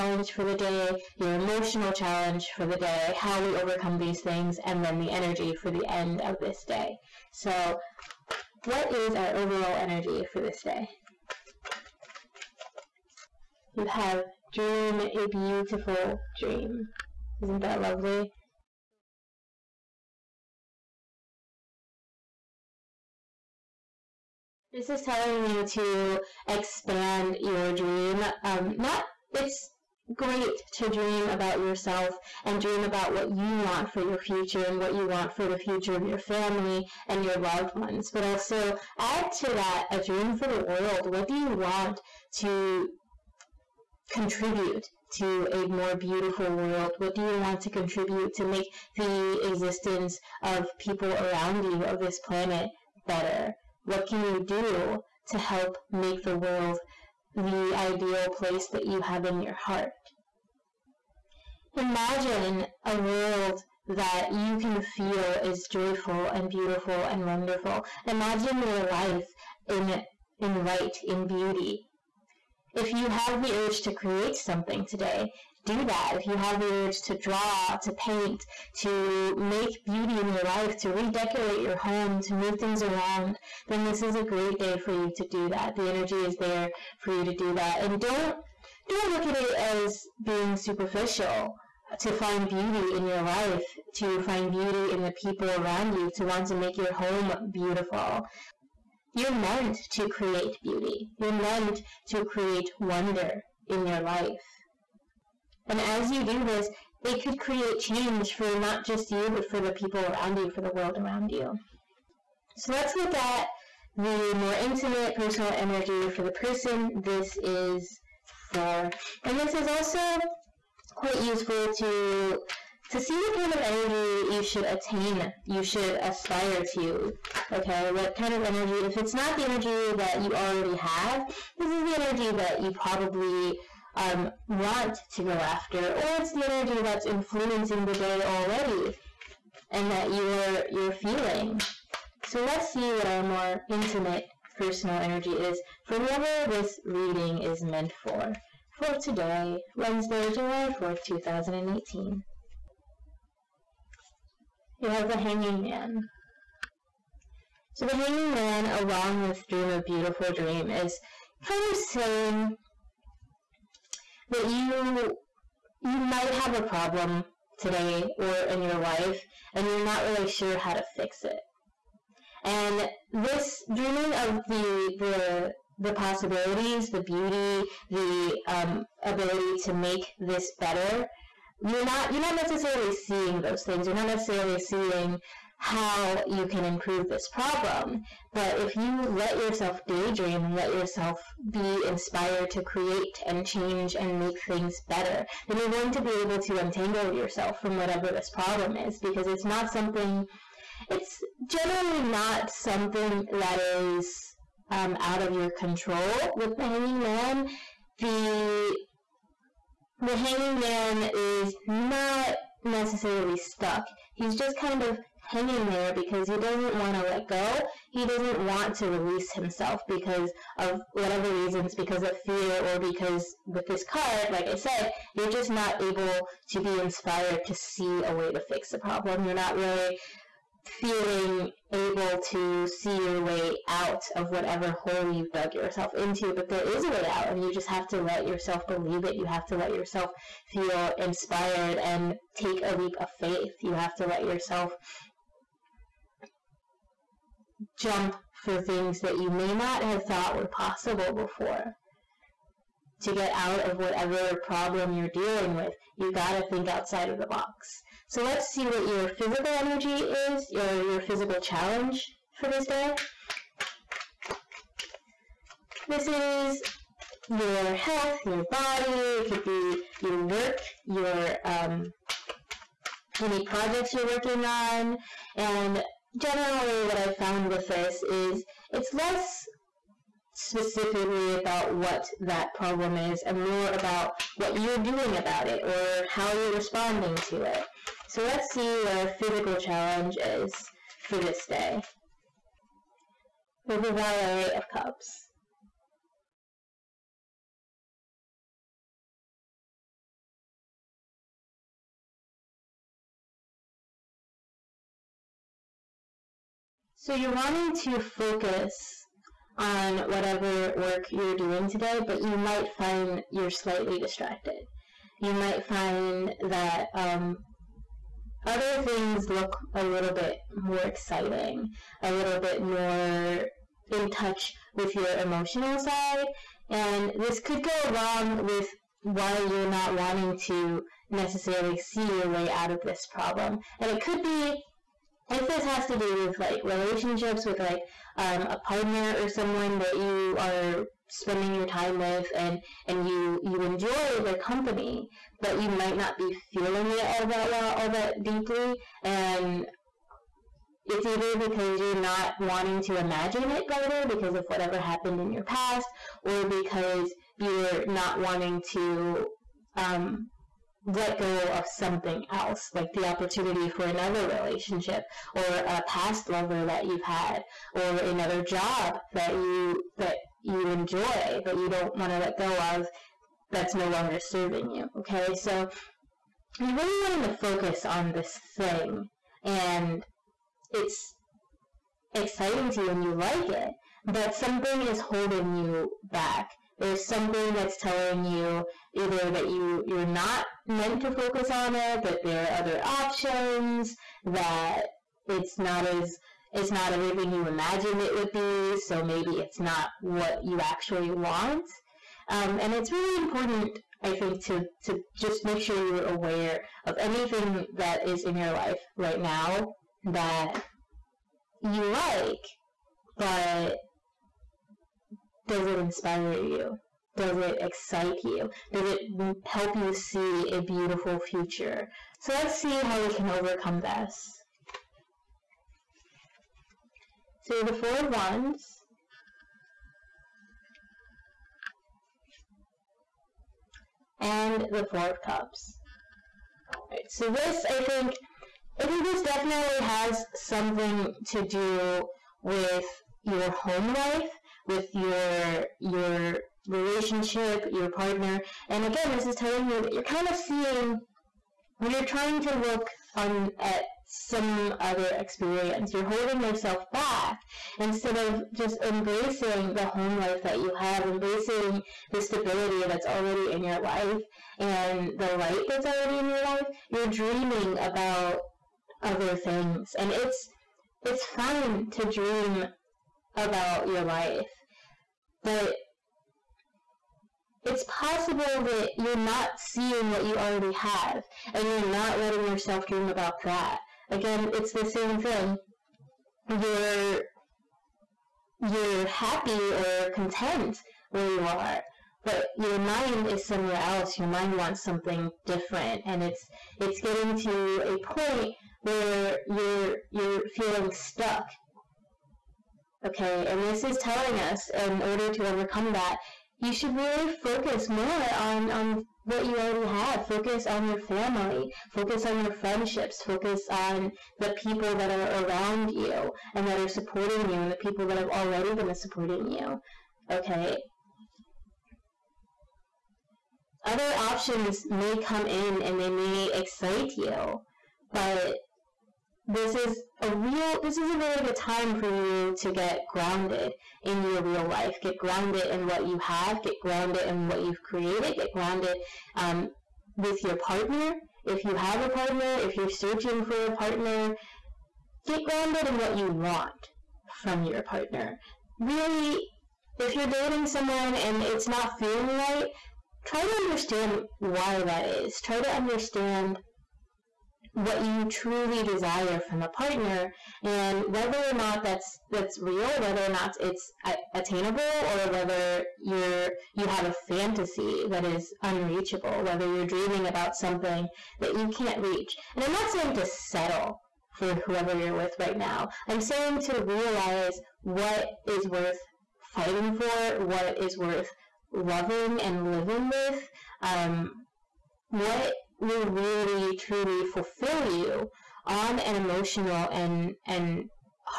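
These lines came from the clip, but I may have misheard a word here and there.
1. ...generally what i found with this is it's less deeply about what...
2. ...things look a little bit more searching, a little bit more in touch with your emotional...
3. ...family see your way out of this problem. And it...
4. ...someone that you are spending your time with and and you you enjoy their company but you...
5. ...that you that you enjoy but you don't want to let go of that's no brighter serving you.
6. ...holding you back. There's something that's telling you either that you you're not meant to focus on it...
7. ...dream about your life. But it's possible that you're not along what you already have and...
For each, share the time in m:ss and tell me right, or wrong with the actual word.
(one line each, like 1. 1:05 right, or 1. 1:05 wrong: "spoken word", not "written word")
1. 4:36 wrong: "specifically", not "deeply"
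2. 5:18 wrong: "exciting", not "searching"
3. 5:31 wrong: "necessarily", not "family"
4. 5:39 right
5. 6:09 wrong: "longer", not "brighter"
6. 6:24 right
7. 7:52 wrong: "seeing", not "along".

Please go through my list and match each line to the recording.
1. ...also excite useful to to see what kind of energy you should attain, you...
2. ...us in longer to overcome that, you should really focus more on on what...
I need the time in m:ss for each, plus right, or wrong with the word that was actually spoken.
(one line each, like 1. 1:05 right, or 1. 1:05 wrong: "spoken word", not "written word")
1. 1:59 wrong: "quite", not "excite"
2. 8:24 wrong: "order", not "longer".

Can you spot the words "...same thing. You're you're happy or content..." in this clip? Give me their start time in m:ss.
8:04.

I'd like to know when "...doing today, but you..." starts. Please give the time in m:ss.
5:11.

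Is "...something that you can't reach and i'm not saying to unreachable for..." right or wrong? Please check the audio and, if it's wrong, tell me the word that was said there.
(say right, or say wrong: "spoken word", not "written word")
wrong: "settle", not "unreachable".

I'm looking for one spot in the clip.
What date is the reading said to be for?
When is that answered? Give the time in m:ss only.
2:29.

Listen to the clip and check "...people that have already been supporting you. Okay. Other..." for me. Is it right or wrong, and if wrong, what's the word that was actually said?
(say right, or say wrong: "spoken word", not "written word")
right.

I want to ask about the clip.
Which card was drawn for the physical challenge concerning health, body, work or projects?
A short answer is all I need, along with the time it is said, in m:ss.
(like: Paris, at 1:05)
Valet of Cups, at 4:53.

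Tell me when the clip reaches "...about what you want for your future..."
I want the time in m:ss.
0:32.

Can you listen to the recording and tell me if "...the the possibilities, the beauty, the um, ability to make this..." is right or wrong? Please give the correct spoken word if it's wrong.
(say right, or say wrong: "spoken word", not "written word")
right.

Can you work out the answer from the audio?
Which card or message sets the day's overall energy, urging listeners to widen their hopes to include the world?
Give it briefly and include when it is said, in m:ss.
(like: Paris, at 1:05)
Dream a beautiful dream, at 0:14.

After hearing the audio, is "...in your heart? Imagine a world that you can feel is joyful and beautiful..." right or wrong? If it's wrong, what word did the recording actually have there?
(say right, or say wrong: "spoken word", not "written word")
right.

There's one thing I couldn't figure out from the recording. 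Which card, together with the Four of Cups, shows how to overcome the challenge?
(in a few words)
Four of Wands.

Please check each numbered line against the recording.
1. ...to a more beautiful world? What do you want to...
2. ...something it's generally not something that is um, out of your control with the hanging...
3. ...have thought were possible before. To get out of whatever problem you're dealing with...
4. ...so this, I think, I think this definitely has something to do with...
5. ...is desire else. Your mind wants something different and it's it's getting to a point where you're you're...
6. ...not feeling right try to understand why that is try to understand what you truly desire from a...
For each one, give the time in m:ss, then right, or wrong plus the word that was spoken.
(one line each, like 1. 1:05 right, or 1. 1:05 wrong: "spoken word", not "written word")
1. 0:45 right
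2. 3:19 right
3. 4:09 right
4. 7:17 right
5. 8:13 wrong: "somewhere", not "desire"
6. 9:11 right.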